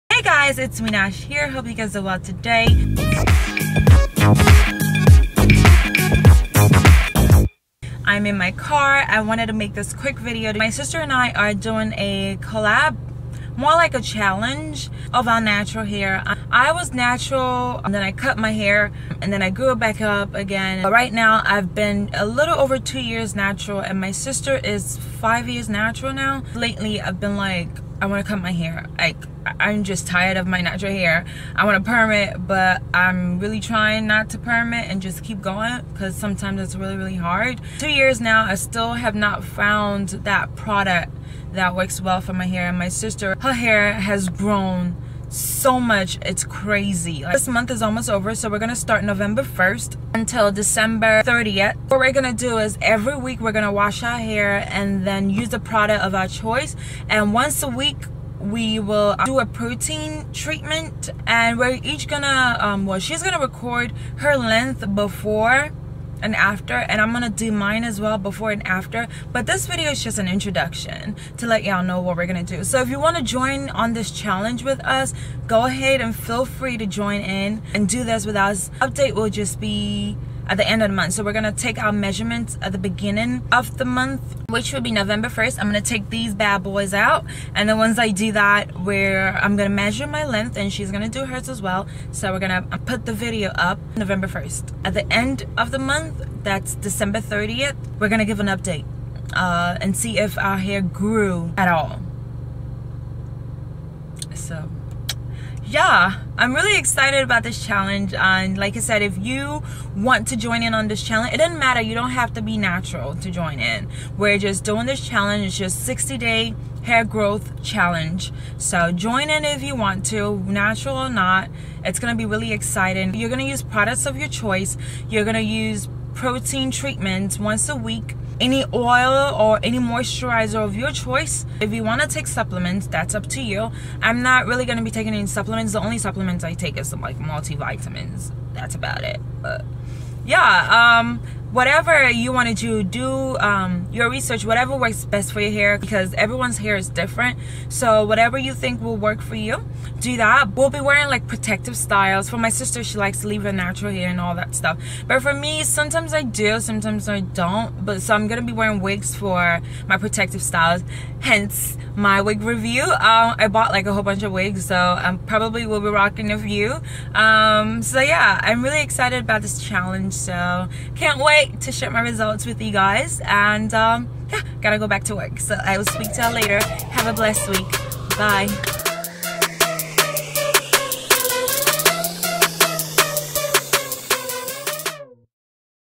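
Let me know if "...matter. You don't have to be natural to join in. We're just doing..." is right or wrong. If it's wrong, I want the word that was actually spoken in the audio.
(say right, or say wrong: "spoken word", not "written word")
right.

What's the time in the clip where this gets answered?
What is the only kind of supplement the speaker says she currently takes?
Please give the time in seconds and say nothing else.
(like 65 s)
137 s.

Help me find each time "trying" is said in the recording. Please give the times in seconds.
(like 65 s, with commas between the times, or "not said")
33 s.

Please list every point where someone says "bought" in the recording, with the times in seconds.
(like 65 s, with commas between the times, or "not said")
163 s.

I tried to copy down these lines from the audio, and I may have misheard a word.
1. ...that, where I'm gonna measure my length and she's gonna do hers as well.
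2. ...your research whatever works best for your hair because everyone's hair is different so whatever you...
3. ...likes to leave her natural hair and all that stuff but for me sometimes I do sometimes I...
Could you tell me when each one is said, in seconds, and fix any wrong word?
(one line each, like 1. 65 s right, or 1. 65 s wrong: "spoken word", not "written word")
1. 88 s right
2. 143 s right
3. 152 s right.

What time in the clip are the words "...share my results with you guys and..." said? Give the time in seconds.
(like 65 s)
171 s.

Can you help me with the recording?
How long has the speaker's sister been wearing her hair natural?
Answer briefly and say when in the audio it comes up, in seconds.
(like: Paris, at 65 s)
5 years, at 24 s.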